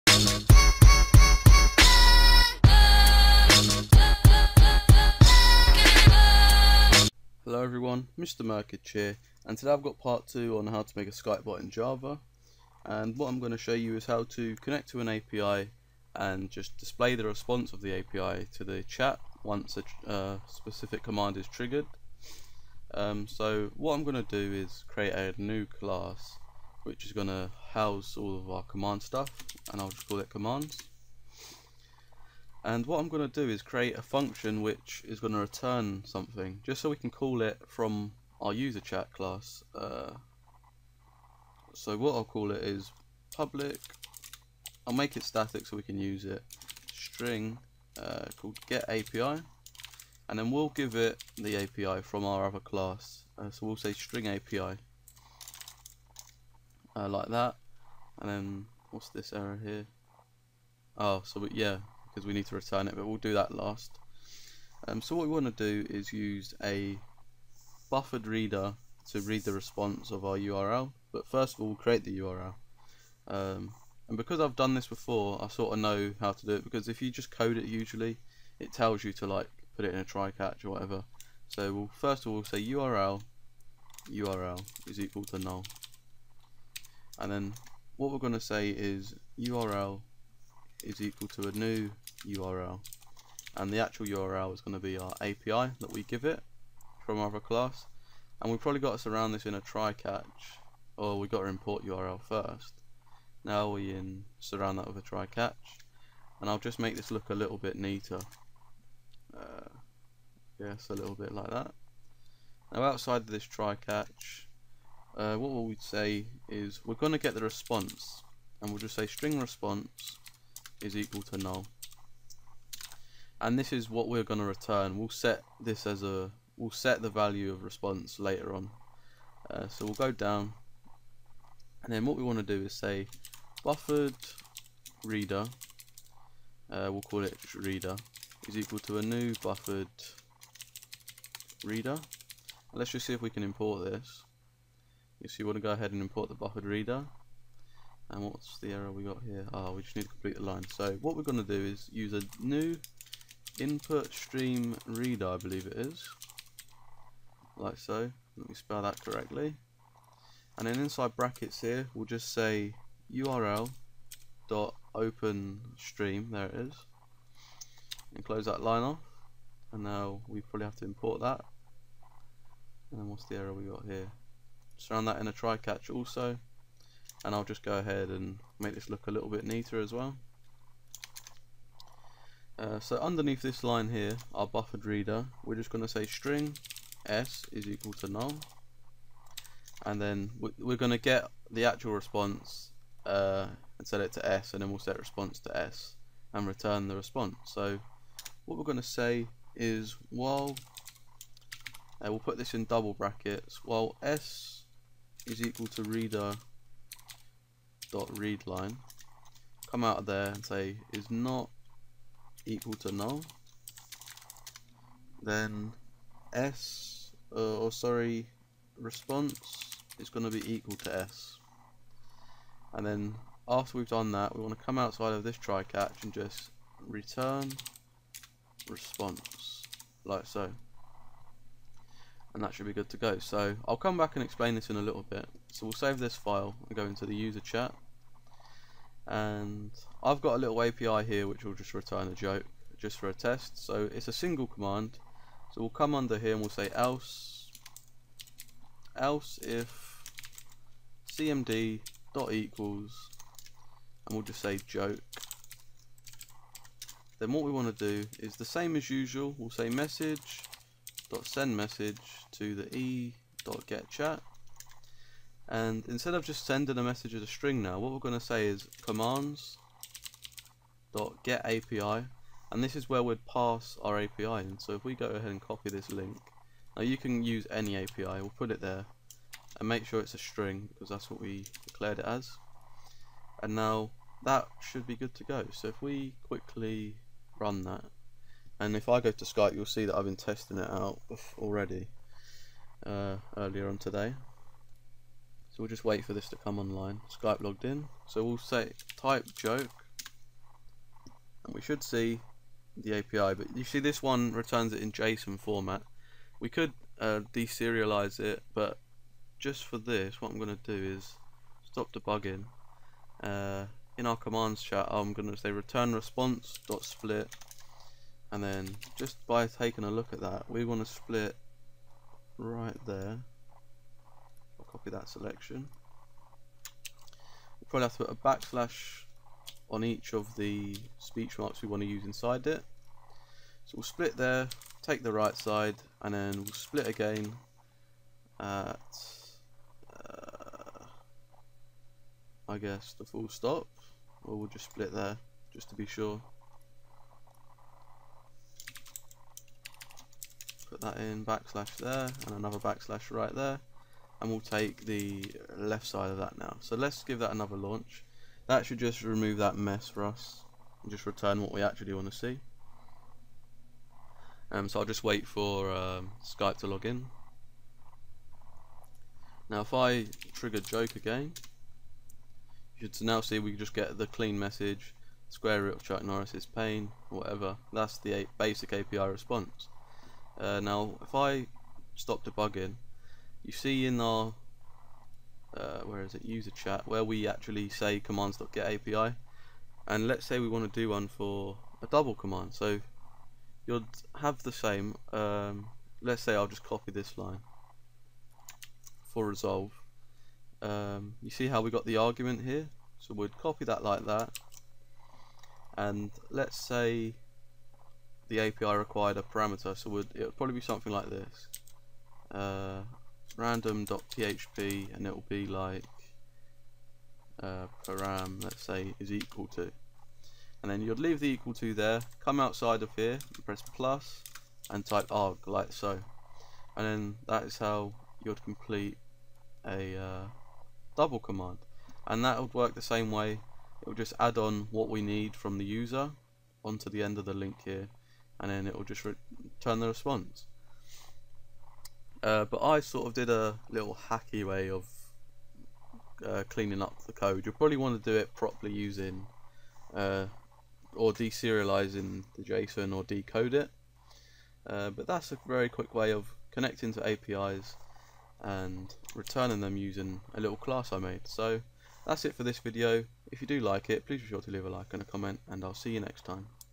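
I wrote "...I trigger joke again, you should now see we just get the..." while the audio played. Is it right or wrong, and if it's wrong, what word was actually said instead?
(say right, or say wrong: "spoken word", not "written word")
right.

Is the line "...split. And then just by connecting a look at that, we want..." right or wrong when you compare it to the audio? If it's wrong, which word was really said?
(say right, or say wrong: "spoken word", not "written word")
wrong: "taking", not "connecting".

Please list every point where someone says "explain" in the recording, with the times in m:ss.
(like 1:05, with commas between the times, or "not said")
3:54.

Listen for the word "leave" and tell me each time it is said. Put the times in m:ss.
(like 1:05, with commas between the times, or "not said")
7:00, 7:44.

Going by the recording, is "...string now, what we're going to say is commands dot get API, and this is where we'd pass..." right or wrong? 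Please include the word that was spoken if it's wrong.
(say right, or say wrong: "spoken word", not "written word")
right.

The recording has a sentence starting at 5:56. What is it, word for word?
So let's give that another launch.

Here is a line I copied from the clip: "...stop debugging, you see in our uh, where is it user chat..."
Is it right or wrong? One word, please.
right.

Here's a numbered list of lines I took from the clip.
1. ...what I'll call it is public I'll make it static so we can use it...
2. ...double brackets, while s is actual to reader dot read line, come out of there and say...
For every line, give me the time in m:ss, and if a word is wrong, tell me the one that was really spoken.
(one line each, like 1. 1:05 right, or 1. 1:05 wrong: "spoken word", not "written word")
1. 0:41 right
2. 3:22 wrong: "equal", not "actual".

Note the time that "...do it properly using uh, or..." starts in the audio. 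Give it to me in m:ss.
7:28.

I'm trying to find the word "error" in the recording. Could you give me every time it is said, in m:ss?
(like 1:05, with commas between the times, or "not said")
0:59, 2:28, 2:53.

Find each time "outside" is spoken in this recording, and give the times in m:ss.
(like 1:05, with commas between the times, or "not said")
1:52, 3:44, 7:02.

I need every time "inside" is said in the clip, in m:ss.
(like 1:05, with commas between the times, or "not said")
2:40, 5:32.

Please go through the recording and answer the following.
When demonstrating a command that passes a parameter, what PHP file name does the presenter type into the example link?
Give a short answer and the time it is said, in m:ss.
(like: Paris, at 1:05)
random.php, at 6:53.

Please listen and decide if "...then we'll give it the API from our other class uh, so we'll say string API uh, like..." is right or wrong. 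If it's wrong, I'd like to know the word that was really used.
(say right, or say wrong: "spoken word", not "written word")
right.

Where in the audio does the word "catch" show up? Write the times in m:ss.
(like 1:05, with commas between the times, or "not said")
1:20, 1:39, 1:45, 1:53, 2:55, 3:45.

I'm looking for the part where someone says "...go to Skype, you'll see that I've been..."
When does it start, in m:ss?
4:49.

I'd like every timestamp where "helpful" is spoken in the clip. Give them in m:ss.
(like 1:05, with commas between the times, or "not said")
not said.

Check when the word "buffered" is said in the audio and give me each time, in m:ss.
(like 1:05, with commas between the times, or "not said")
1:07, 2:13, 2:19, 2:26, 3:04.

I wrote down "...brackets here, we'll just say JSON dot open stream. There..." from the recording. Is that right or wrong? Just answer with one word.
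wrong.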